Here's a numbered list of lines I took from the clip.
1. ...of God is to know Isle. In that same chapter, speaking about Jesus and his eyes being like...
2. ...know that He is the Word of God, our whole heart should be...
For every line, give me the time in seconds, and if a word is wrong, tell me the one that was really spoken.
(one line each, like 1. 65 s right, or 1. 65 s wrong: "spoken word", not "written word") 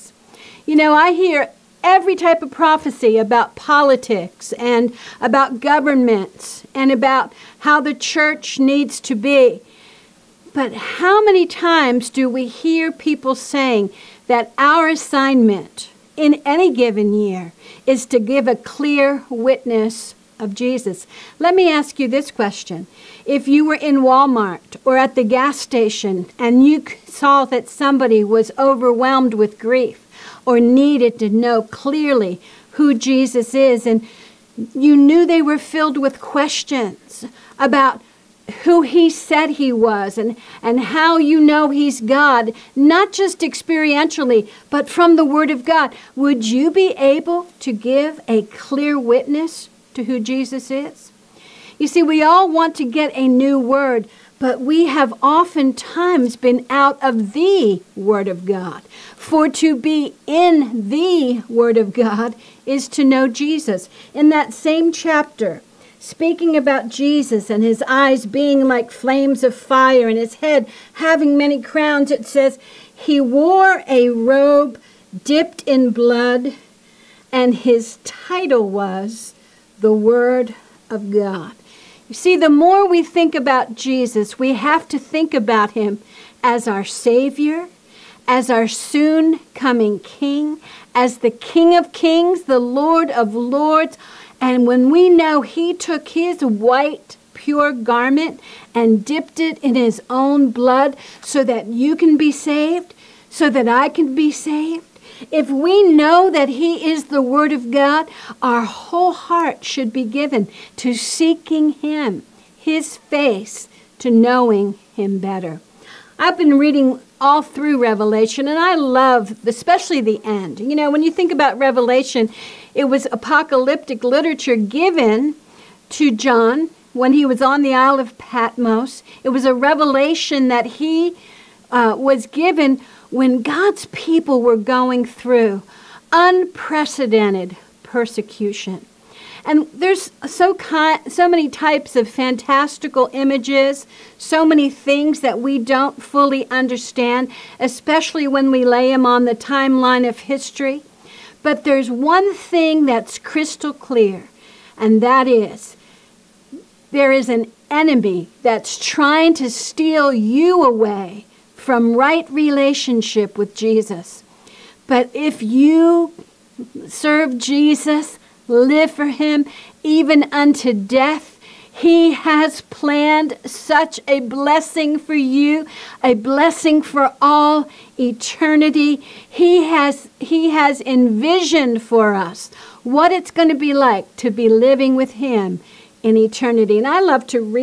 1. 61 s wrong: "Jesus", not "Isle"
2. 105 s right.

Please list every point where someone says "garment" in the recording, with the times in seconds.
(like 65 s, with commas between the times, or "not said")
97 s.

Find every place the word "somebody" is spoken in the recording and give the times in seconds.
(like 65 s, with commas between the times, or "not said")
27 s.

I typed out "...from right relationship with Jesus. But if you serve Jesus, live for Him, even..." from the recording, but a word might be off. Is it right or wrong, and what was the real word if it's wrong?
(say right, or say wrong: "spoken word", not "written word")
right.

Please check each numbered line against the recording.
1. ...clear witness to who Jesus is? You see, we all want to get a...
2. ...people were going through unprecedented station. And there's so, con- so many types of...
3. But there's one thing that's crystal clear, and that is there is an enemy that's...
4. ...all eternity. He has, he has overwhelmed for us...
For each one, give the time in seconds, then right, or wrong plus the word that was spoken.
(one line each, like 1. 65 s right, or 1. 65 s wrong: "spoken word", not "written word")
1. 48 s right
2. 133 s wrong: "persecution", not "station"
3. 151 s right
4. 177 s wrong: "envisioned", not "overwhelmed".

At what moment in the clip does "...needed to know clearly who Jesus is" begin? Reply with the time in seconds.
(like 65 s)
30 s.